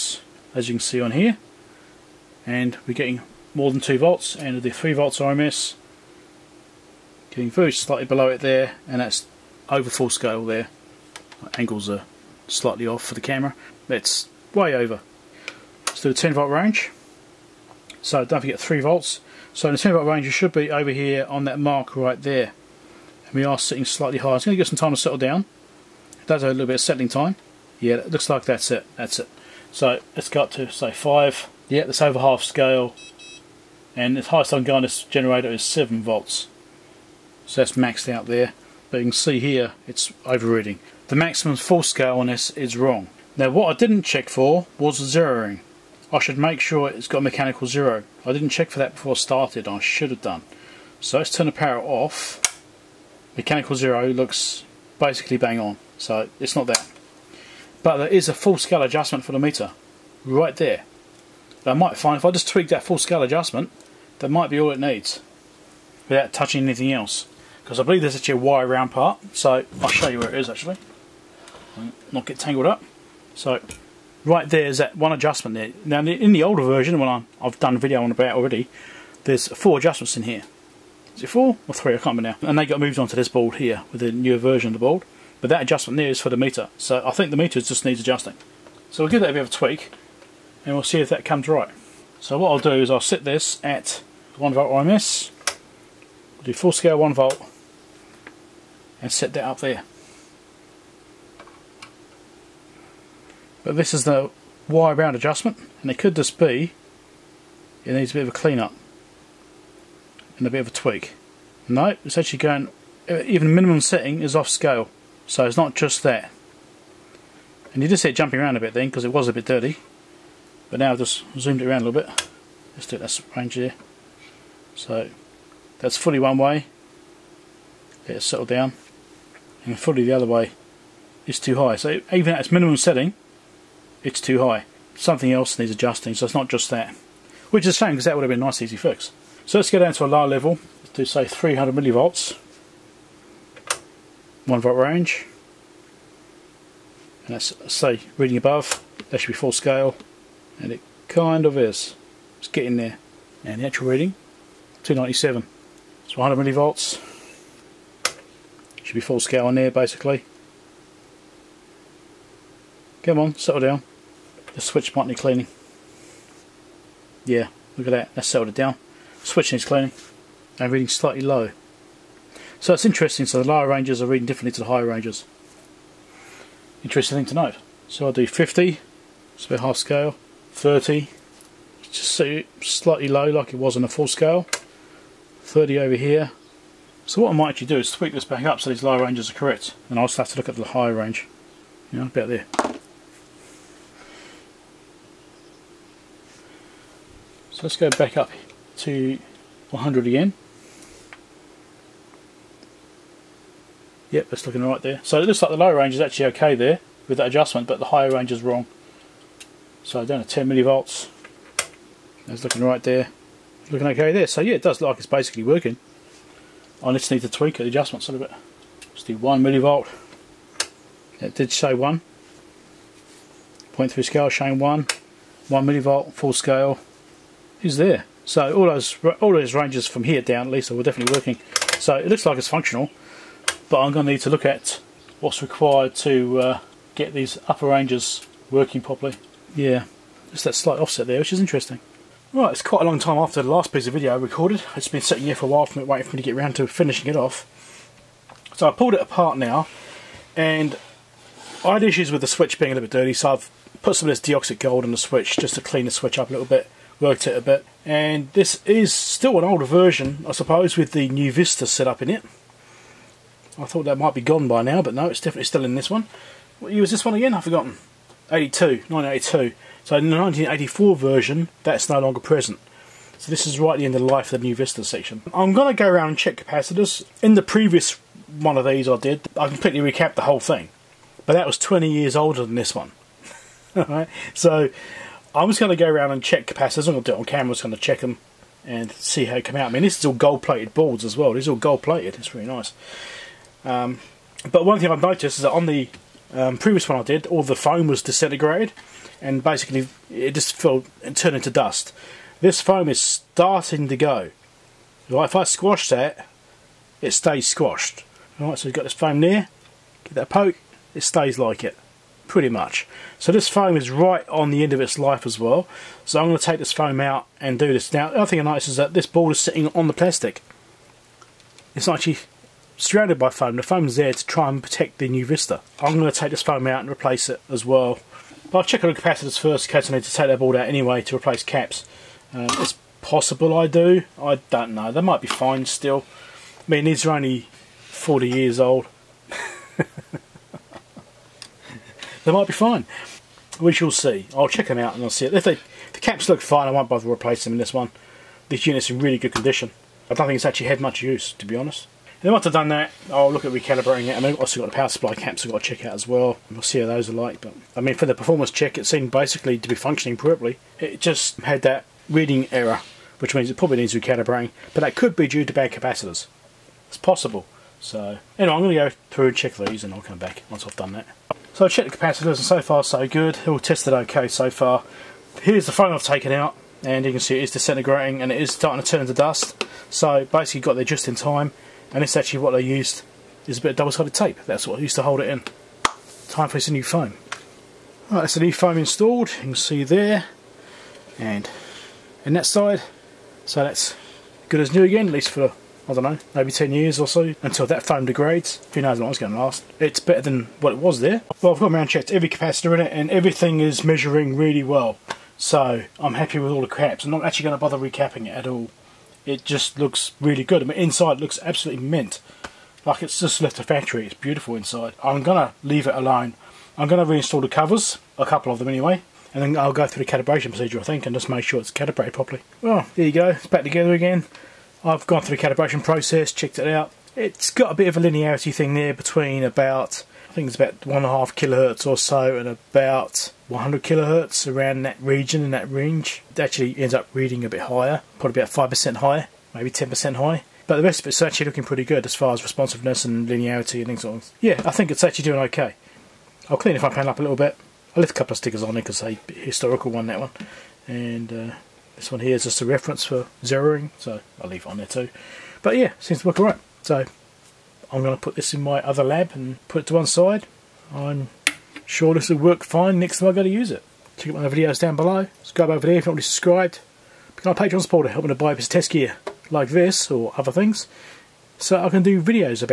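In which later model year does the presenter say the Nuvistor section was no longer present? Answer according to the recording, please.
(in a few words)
1984.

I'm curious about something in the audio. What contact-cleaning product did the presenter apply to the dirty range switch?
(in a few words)
DeoxIT gold.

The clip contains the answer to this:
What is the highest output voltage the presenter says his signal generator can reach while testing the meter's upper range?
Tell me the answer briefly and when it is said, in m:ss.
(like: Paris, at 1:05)
7 volts, at 0:35.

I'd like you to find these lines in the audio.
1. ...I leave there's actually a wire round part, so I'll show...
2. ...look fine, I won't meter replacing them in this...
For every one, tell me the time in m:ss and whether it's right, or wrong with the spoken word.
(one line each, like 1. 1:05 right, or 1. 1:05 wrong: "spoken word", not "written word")
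1. 1:07 wrong: "believe", not "leave"
2. 5:46 wrong: "bother", not "meter".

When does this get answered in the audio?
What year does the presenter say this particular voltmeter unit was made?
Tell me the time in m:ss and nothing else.
4:28.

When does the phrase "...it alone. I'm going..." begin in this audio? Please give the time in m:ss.
6:55.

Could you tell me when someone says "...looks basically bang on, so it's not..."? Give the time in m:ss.
0:54.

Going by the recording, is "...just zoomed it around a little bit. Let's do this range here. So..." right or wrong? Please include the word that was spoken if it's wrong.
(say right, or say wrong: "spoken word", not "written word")
right.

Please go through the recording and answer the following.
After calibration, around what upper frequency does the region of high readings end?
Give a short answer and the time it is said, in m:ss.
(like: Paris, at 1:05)
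100 kilohertz, at 7:13.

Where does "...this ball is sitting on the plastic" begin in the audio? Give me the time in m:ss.
5:18.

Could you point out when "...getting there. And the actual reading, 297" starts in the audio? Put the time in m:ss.
2:32.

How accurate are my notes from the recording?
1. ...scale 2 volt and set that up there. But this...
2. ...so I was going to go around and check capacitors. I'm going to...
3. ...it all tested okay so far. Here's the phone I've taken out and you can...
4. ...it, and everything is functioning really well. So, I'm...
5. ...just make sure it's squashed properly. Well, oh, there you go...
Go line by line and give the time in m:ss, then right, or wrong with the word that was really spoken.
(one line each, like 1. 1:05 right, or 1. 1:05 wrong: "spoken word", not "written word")
1. 1:36 wrong: "1", not "2"
2. 4:44 right
3. 6:13 right
4. 6:42 wrong: "measuring", not "functioning"
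5. 7:01 wrong: "calibrated", not "squashed".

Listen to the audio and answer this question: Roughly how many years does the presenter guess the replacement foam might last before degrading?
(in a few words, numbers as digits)
10 years.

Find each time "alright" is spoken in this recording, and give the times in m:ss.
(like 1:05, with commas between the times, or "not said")
4:43, 5:08, 6:28, 7:36.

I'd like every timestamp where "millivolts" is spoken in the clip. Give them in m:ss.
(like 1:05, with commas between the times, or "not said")
2:21, 2:36, 3:30, 3:39, 3:45.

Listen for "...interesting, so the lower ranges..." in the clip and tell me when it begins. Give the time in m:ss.
2:52.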